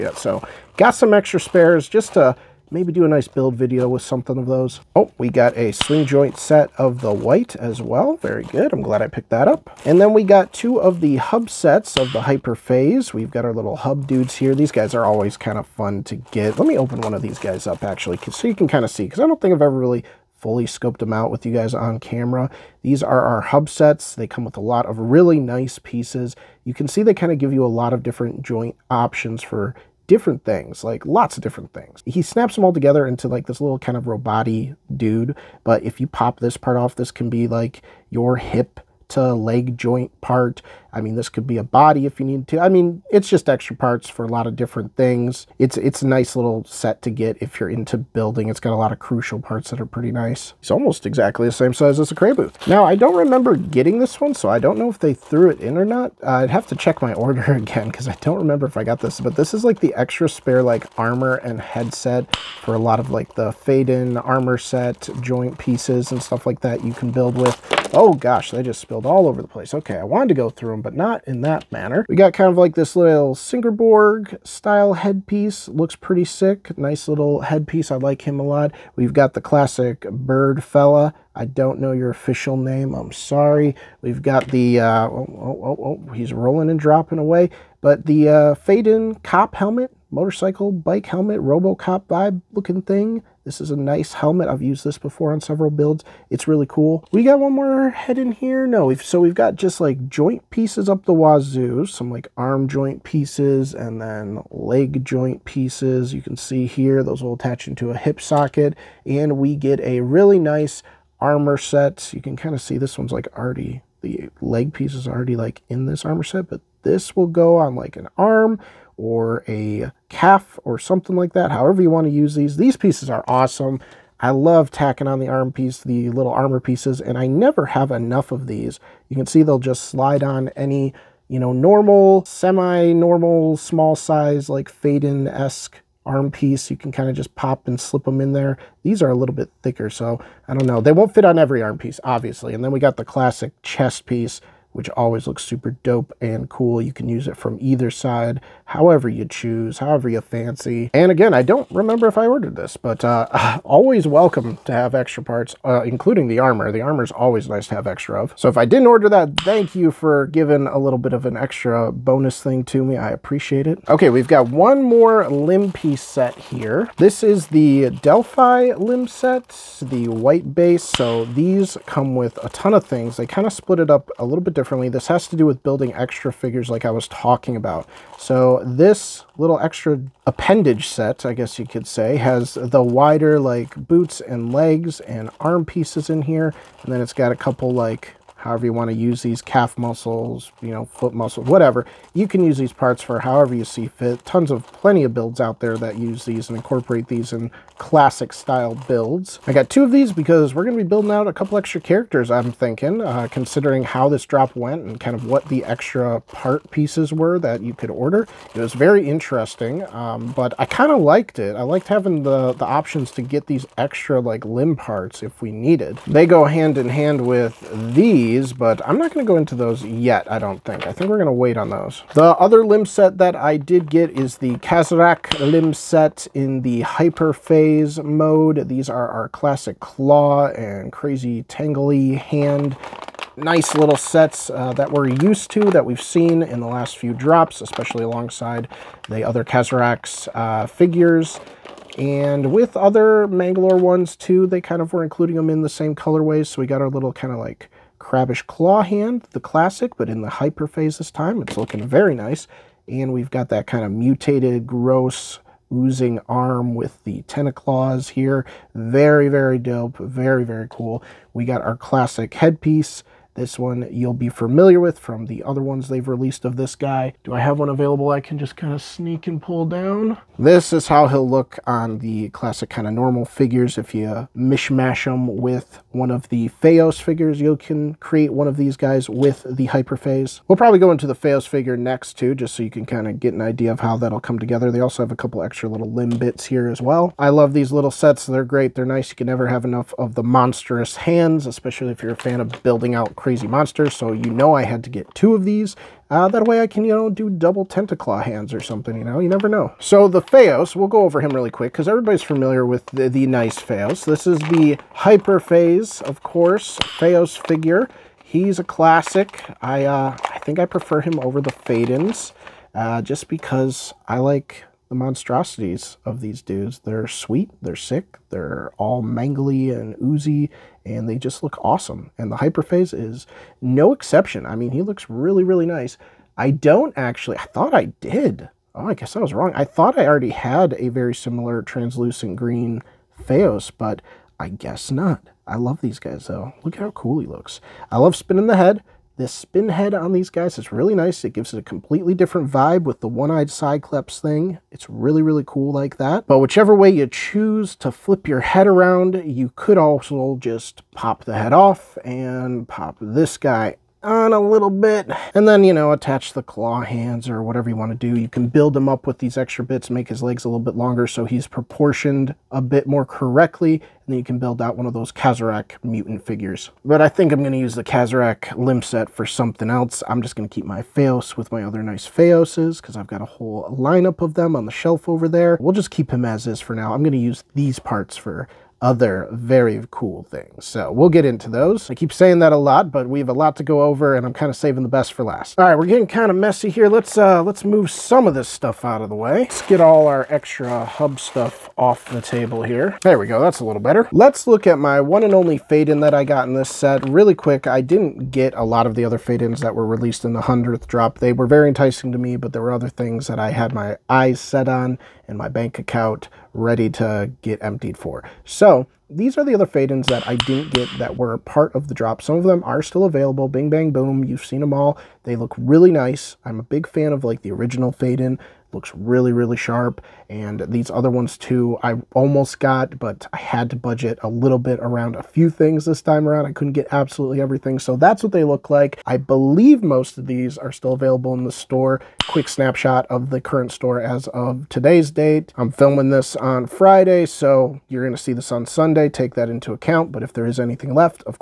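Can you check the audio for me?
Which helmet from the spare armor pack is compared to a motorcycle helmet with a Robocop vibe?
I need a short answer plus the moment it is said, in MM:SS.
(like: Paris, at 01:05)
Pheyden cop helmet, at 01:28.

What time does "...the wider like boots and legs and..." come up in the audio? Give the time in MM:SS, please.
03:02.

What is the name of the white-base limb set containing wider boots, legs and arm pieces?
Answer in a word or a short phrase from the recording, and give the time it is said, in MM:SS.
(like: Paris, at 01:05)
Delphi limb set, at 02:47.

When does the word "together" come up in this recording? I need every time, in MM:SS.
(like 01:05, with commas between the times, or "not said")
00:32, 04:44.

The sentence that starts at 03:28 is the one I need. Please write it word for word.
It was very interesting, um, but I kind of liked it.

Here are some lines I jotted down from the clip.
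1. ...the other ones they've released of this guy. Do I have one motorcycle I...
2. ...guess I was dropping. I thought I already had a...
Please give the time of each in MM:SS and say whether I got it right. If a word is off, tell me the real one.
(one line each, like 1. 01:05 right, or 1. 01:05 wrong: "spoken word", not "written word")
1. 04:25 wrong: "available", not "motorcycle"
2. 05:28 wrong: "wrong", not "dropping".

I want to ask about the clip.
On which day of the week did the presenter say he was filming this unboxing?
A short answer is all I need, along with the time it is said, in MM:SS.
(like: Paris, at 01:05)
Friday, at 07:16.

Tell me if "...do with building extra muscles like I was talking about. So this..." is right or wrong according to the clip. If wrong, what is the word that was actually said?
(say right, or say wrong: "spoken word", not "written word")
wrong: "figures", not "muscles".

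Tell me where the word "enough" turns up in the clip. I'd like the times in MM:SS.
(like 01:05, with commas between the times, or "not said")
02:07, 04:49.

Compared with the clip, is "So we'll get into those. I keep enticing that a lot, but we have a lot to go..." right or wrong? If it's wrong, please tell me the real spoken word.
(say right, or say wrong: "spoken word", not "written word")
wrong: "saying", not "enticing".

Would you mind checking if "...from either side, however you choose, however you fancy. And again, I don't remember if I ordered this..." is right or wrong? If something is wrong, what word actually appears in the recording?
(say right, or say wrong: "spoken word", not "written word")
right.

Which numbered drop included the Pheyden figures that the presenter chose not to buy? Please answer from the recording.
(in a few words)
100th drop.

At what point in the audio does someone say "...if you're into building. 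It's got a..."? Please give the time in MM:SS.
00:47.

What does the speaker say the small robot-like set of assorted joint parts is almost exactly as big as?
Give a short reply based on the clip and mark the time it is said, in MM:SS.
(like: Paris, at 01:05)
A Cray booth, at 00:52.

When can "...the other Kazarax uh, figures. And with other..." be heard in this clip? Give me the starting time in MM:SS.
03:59.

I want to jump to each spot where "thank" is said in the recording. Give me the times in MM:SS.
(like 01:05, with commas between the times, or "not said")
02:39.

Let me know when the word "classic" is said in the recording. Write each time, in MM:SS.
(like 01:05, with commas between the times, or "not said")
01:19, 02:23, 03:17, 03:49, 04:09, 04:21, 04:32, 05:08.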